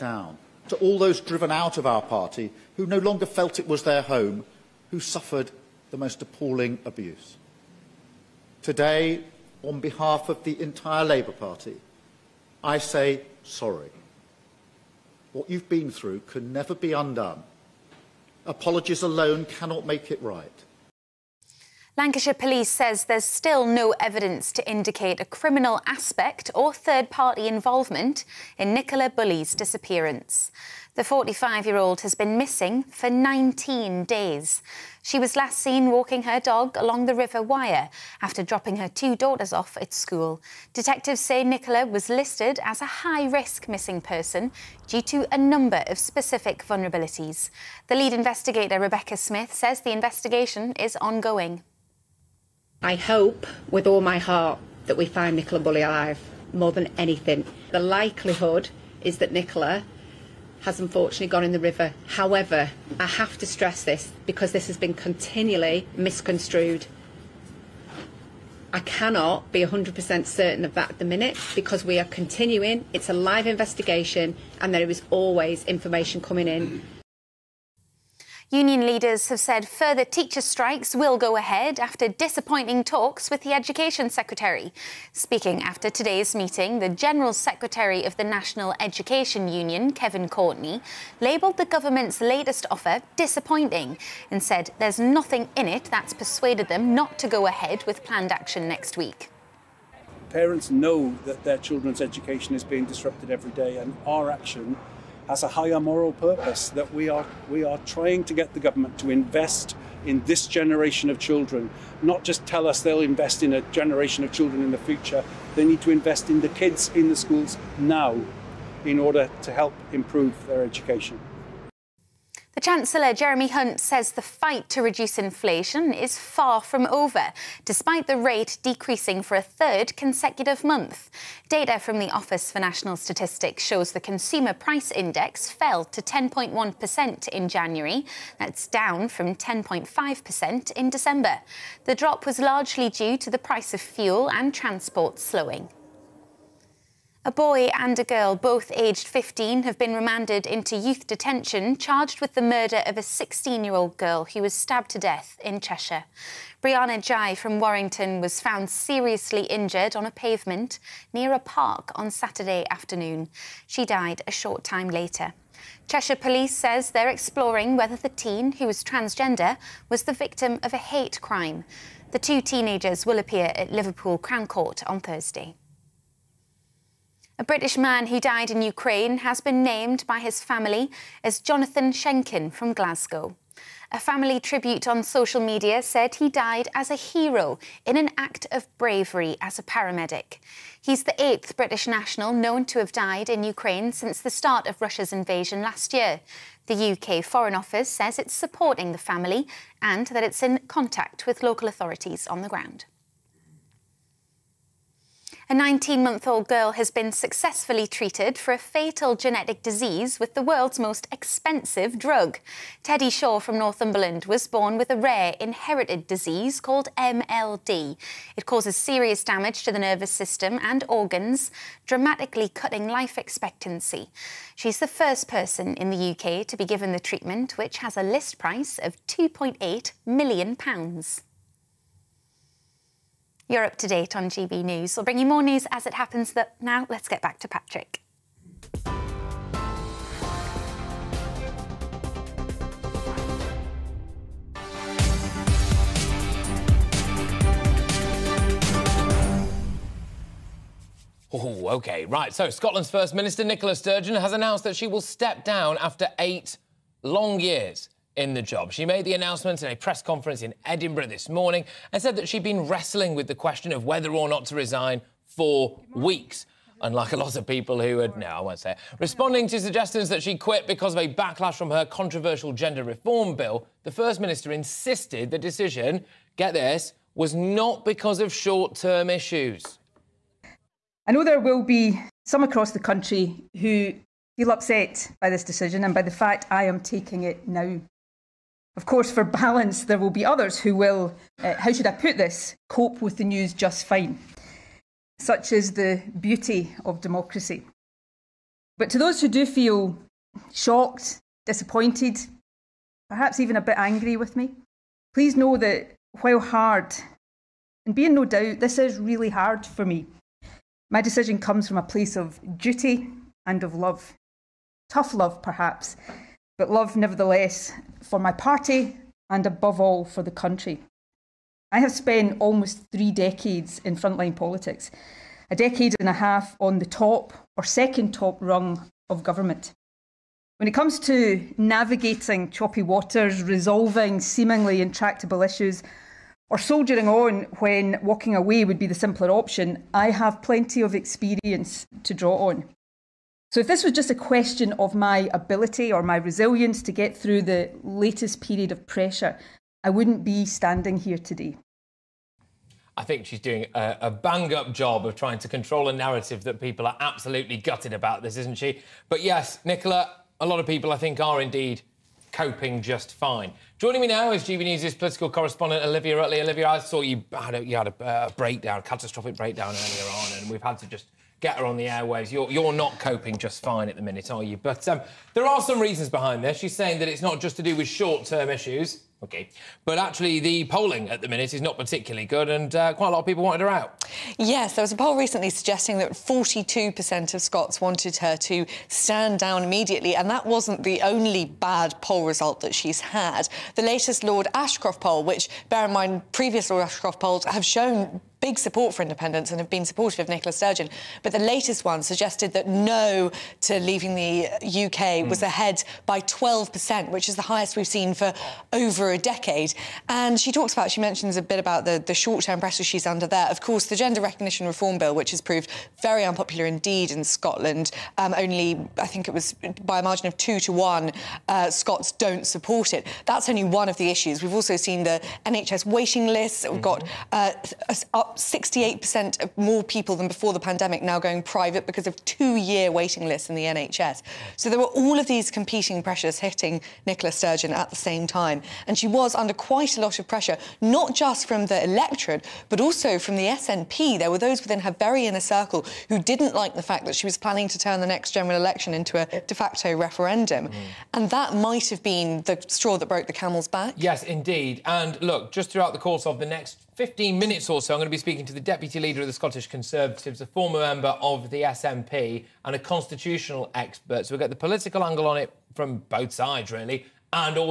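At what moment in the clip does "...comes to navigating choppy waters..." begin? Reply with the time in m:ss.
5:30.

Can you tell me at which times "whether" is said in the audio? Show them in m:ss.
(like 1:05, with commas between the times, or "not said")
2:47, 4:23.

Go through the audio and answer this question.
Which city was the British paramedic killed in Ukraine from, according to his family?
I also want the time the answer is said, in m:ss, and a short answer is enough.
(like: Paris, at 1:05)
Glasgow, at 3:02.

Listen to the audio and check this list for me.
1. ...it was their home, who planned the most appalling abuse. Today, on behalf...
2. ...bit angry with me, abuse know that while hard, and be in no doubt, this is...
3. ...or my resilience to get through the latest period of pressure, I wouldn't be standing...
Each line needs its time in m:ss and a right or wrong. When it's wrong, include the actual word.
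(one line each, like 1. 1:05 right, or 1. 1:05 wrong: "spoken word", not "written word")
1. 0:03 wrong: "suffered", not "planned"
2. 5:03 wrong: "please", not "abuse"
3. 5:45 right.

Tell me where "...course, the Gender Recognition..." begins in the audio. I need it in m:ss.
6:53.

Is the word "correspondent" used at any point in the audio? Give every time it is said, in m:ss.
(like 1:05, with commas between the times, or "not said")
6:05.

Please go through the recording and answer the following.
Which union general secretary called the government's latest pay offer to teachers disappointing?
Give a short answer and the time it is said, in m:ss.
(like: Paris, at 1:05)
Kevin Courtney, at 1:29.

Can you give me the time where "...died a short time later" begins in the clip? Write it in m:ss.
2:43.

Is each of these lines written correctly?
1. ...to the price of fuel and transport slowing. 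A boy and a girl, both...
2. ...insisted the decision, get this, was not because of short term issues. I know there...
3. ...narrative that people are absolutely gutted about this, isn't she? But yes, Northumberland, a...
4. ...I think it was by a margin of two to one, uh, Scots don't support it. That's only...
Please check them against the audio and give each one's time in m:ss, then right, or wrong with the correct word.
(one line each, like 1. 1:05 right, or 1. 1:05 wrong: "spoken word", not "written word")
1. 2:23 right
2. 4:34 right
3. 5:55 wrong: "Nicola", not "Northumberland"
4. 6:58 right.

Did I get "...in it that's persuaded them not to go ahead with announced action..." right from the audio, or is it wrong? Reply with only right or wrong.
wrong.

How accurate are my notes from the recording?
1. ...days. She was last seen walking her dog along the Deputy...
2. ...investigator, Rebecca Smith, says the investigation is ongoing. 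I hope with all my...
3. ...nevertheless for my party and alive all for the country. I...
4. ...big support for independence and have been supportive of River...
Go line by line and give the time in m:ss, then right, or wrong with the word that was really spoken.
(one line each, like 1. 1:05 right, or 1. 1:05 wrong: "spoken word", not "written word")
1. 0:34 wrong: "River", not "Deputy"
2. 0:48 right
3. 5:16 wrong: "above", not "alive"
4. 6:38 wrong: "Nicola", not "River".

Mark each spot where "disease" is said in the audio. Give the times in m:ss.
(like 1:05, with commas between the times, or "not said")
3:29, 3:36.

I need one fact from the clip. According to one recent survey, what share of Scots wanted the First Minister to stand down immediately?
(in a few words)
42%.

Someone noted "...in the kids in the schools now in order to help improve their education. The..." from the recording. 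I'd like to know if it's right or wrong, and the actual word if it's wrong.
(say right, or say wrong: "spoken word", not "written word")
right.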